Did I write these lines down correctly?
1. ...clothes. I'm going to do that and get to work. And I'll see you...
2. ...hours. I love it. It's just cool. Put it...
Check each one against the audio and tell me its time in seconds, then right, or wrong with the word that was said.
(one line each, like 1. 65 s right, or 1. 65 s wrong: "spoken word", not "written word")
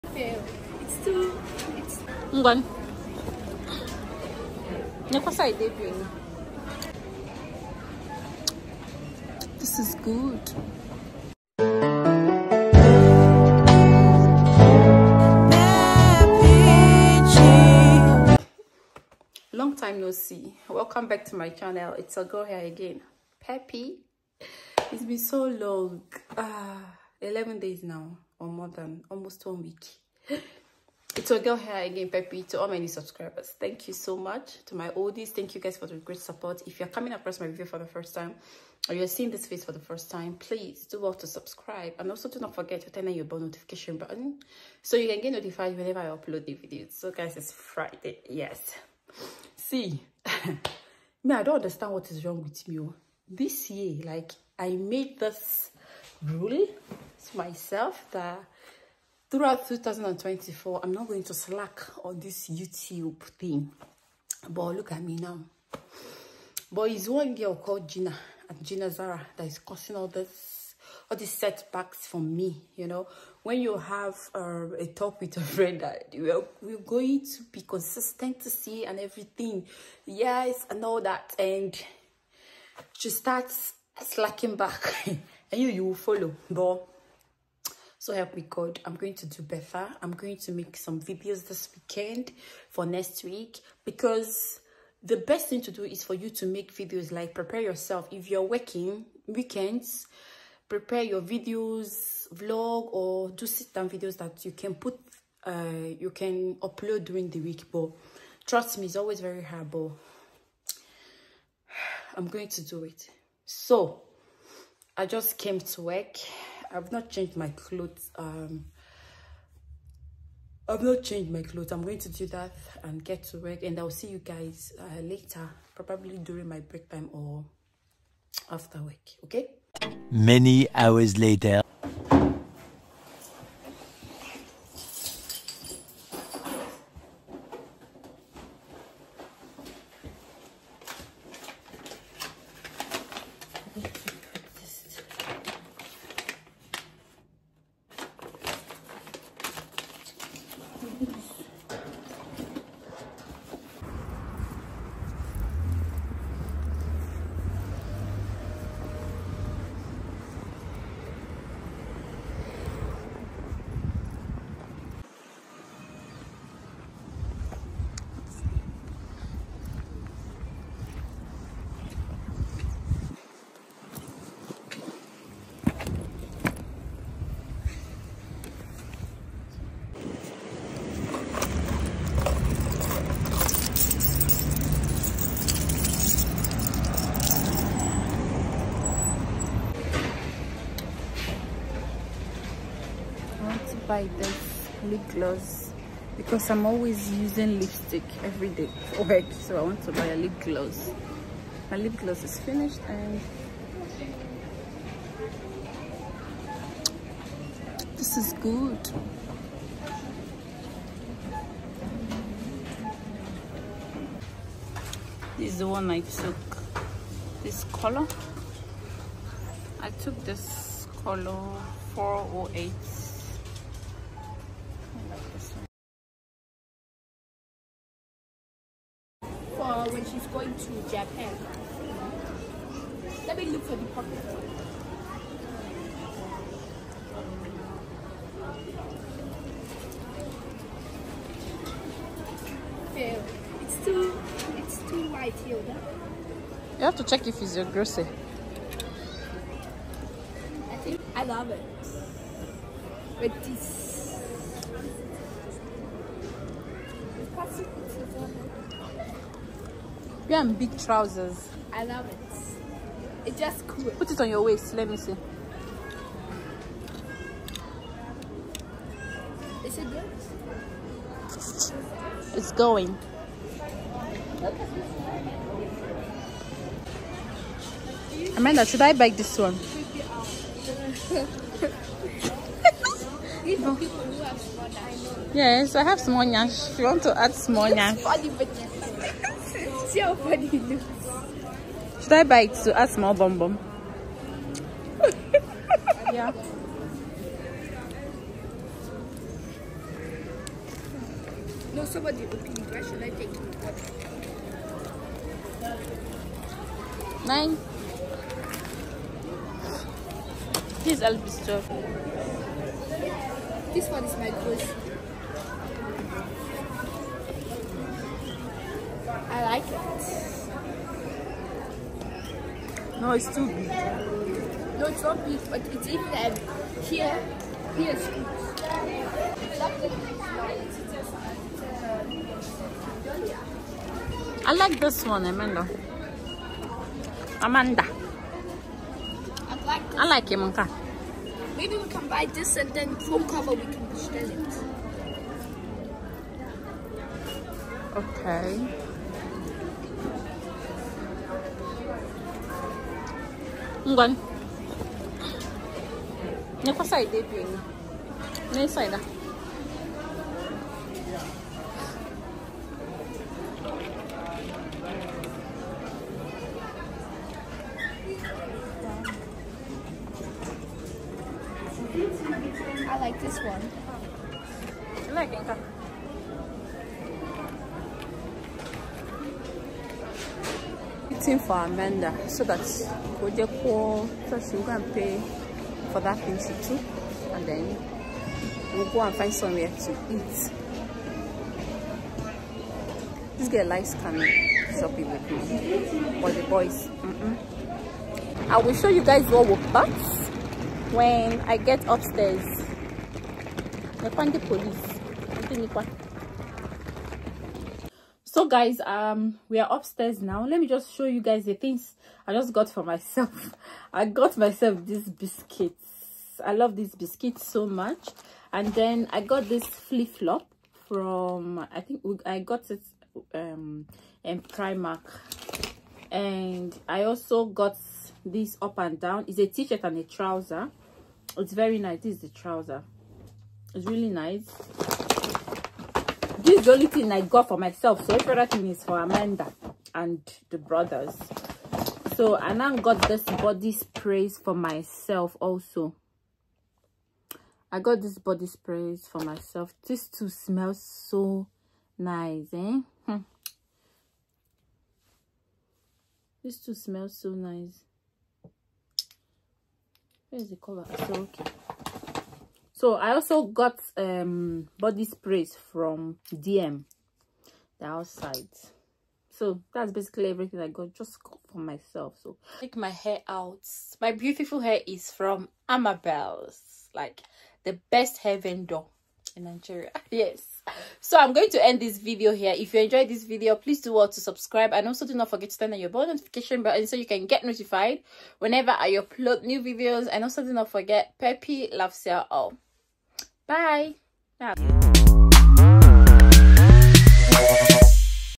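1. 121 s right
2. 260 s wrong: "trousers", not "hours".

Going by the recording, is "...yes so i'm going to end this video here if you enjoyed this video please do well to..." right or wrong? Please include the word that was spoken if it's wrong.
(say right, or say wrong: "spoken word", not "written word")
right.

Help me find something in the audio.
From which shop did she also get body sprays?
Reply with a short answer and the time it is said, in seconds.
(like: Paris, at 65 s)
dm, at 466 s.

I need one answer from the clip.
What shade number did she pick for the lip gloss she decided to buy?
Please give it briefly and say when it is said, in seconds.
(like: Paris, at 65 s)
408, at 221 s.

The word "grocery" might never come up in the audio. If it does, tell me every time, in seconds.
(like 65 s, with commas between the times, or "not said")
247 s, 314 s.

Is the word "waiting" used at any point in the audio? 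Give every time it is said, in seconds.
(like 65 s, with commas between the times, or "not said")
381 s.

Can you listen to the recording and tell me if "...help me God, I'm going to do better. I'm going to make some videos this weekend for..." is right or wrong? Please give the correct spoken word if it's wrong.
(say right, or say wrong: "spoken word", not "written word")
right.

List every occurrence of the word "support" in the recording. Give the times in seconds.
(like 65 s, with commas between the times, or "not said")
36 s.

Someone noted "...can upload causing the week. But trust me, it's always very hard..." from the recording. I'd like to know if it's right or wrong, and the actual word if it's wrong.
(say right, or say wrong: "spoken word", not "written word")
wrong: "during", not "causing".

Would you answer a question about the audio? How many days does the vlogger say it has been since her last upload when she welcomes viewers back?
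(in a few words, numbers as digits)
11.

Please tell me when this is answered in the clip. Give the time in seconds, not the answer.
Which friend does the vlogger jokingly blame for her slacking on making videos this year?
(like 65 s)
68 s.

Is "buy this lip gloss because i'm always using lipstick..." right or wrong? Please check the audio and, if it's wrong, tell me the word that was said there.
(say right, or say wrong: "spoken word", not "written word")
right.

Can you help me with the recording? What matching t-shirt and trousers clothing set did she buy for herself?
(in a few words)
Up and down.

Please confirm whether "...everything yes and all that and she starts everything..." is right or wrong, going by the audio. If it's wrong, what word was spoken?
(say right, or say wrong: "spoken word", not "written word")
wrong: "slacking", not "everything".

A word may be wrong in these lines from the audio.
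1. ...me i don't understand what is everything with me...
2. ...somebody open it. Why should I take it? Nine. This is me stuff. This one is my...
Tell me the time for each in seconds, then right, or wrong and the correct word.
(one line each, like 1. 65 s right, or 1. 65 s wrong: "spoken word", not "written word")
1. 51 s wrong: "wrong", not "everything"
2. 301 s right.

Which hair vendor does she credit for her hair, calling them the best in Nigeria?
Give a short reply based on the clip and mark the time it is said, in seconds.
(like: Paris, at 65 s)
Amabel's, at 475 s.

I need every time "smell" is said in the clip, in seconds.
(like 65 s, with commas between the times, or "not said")
450 s, 456 s.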